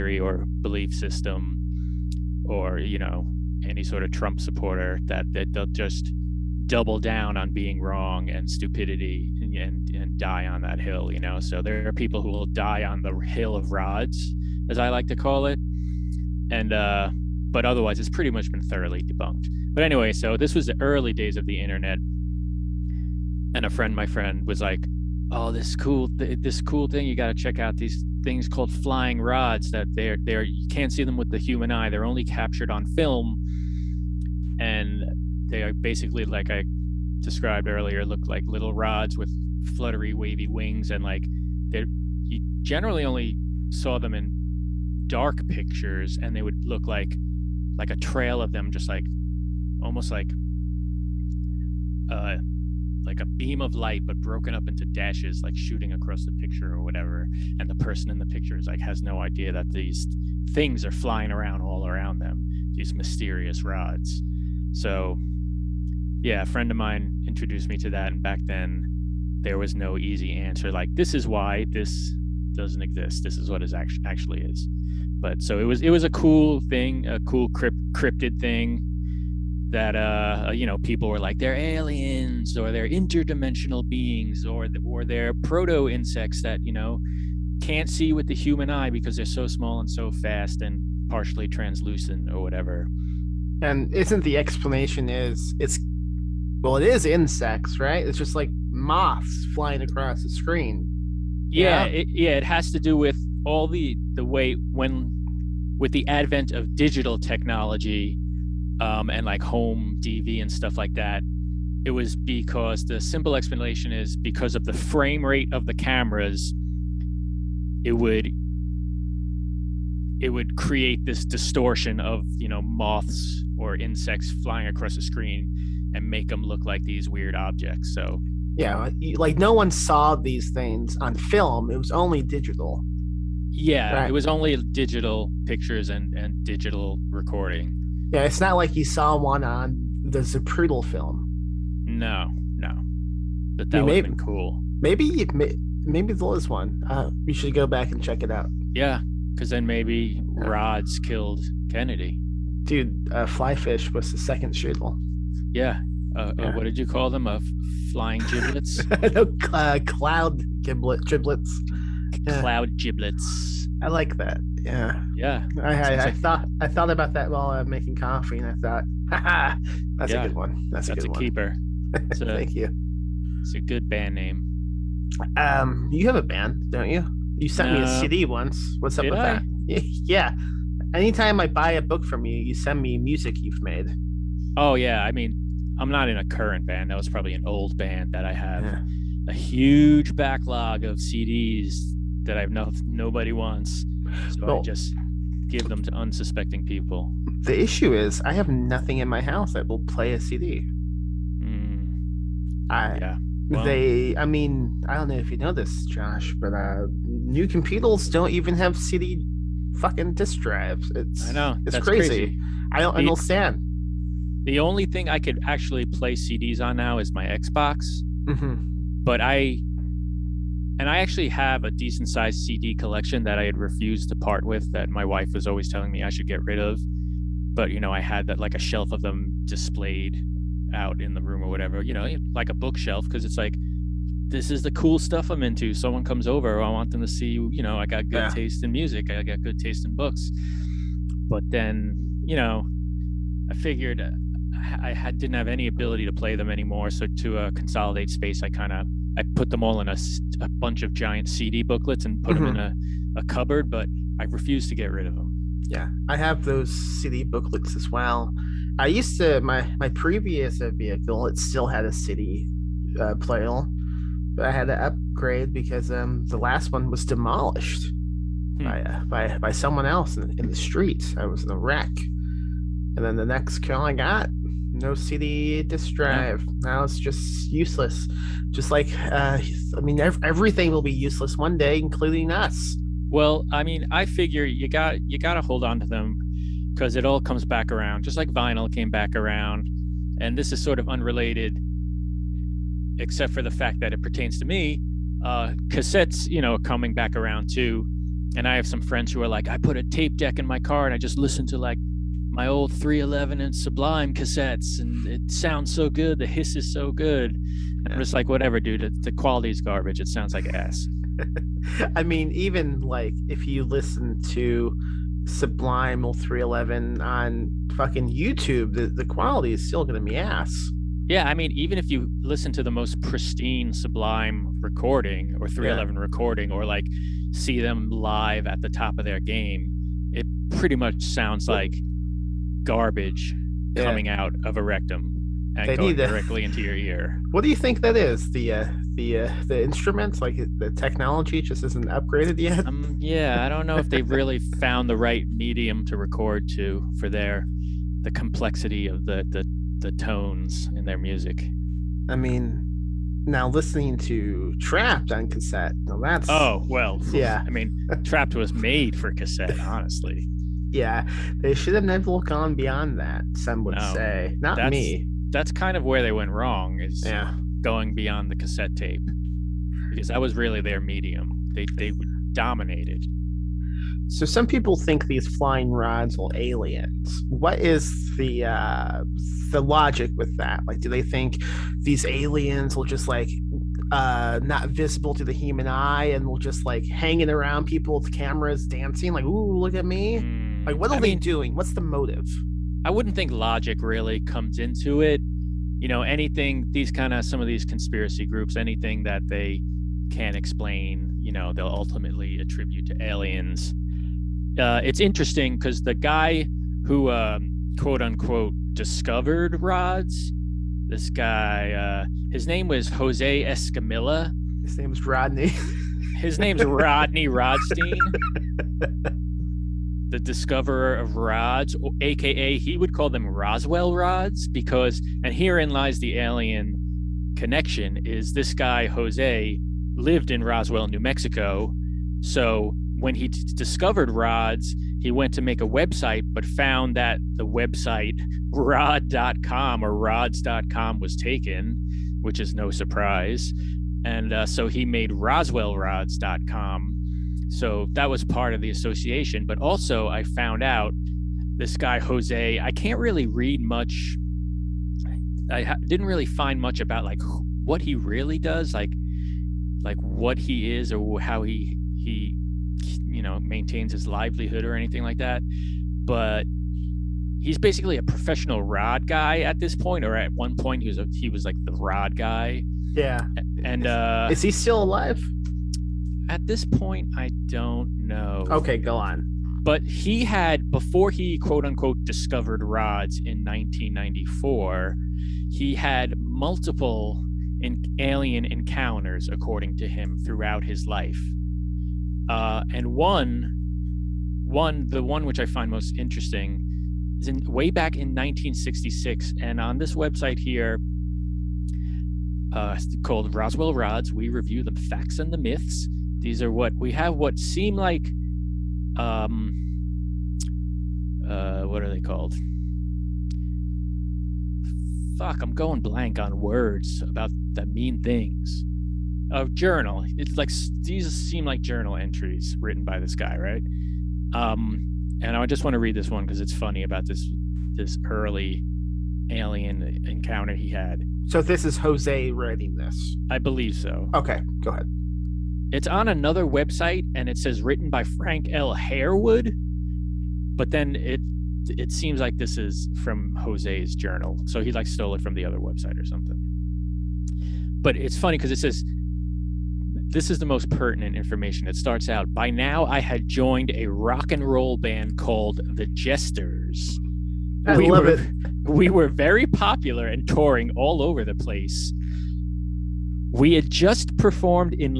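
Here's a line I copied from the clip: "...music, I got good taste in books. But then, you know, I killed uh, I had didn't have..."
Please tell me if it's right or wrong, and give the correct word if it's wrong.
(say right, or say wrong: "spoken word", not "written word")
wrong: "figured", not "killed".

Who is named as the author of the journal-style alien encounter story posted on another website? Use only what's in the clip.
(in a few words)
Frank L. Harewood.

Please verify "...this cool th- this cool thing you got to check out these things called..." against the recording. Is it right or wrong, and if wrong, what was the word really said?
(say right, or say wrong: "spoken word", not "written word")
right.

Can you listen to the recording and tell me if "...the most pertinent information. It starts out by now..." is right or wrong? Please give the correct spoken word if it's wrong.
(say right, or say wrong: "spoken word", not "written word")
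right.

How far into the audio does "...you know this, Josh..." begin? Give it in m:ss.
3:25.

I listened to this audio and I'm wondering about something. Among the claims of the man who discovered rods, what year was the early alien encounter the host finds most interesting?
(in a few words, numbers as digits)
1966.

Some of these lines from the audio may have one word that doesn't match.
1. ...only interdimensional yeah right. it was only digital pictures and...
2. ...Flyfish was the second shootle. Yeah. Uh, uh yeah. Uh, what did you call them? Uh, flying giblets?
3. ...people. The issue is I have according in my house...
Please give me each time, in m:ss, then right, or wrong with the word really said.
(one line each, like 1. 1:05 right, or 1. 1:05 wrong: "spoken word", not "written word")
1. 2:11 wrong: "digital", not "interdimensional"
2. 2:33 right
3. 3:16 wrong: "nothing", not "according".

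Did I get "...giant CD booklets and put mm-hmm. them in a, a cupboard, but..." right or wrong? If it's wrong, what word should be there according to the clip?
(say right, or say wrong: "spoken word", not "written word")
right.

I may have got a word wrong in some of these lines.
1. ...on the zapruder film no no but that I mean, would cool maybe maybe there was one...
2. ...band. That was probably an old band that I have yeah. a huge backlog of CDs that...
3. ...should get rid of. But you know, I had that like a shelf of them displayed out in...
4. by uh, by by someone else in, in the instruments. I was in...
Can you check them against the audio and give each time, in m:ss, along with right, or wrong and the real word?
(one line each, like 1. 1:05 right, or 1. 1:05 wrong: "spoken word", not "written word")
1. 2:19 right
2. 3:06 right
3. 3:46 right
4. 4:28 wrong: "streets", not "instruments".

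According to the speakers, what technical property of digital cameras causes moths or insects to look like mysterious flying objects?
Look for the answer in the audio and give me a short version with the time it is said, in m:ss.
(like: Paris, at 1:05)
frame rate, at 1:54.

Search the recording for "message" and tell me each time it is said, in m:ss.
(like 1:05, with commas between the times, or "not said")
not said.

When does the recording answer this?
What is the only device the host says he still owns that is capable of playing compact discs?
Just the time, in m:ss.
3:37.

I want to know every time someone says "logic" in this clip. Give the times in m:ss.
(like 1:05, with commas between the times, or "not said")
6:19, 6:33.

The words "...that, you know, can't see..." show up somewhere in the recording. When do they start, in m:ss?
1:26.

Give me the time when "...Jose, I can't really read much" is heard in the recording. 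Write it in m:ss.
7:31.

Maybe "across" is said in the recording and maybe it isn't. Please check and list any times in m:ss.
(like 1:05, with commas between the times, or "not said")
0:55, 1:39, 2:04.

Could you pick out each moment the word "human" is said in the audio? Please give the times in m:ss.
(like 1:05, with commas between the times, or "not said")
0:31, 1:28, 6:25.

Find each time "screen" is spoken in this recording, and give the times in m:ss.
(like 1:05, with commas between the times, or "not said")
1:40, 2:05.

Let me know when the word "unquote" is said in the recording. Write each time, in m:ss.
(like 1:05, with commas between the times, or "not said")
6:48, 8:01.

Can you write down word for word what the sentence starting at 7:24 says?
And uh, so he made roswellrods.com so that was part of the association.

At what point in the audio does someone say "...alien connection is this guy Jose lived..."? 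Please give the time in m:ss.
7:06.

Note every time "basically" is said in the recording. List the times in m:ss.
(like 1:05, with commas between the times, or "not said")
0:35, 7:47.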